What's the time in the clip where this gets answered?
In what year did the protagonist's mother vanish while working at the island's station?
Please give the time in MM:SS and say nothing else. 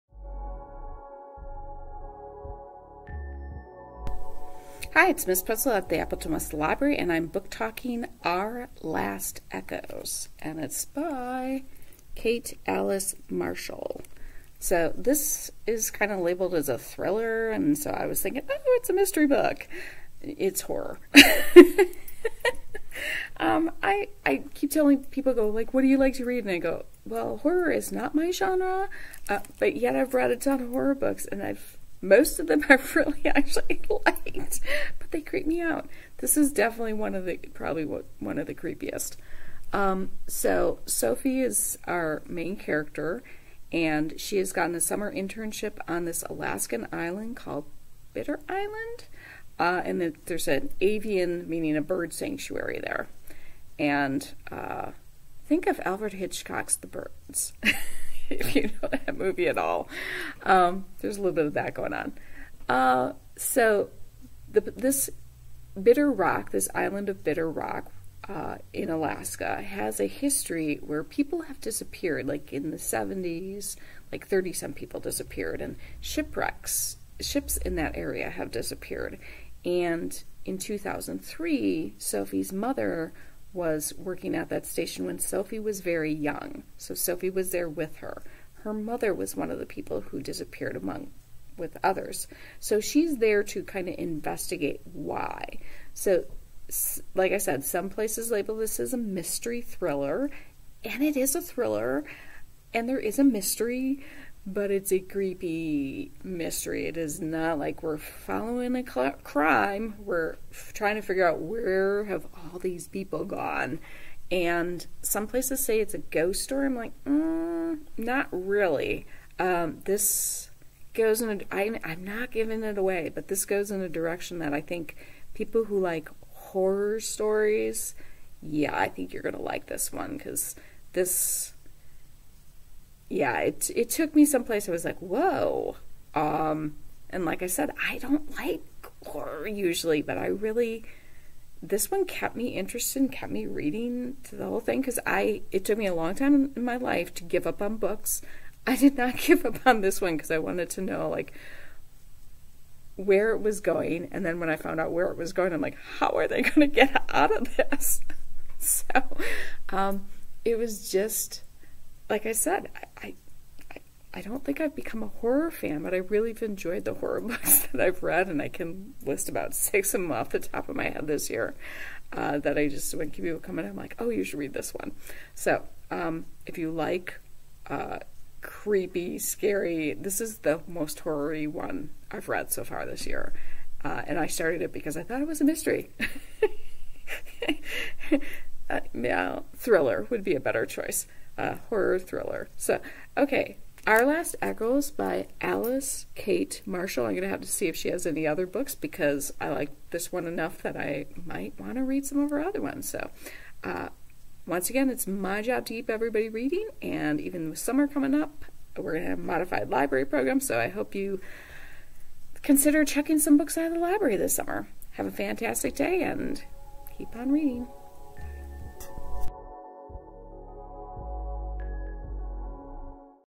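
01:20.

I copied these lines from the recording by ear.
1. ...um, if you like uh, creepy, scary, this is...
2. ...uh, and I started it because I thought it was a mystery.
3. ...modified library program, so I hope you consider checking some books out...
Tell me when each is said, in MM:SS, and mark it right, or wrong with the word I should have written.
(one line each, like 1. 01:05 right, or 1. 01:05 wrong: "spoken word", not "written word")
1. 02:55 right
2. 03:03 right
3. 03:29 right.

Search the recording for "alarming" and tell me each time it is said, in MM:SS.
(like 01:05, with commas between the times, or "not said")
not said.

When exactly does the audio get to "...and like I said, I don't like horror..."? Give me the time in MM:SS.
02:17.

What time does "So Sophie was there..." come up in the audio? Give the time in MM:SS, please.
01:26.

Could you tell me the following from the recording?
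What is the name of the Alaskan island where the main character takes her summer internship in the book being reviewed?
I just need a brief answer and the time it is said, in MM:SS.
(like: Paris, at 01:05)
Bitter Island, at 00:48.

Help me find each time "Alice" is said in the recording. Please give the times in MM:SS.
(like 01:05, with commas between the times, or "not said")
00:12, 03:15.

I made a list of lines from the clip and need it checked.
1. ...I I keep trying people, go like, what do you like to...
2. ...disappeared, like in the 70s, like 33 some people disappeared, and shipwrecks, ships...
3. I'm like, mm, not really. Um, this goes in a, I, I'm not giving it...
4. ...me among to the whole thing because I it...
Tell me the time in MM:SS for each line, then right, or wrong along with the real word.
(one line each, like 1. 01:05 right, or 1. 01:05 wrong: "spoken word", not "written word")
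1. 00:23 wrong: "telling", not "trying"
2. 01:11 wrong: "30", not "33"
3. 01:56 right
4. 02:23 wrong: "reading", not "among".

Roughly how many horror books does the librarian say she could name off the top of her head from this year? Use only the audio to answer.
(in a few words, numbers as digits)
6.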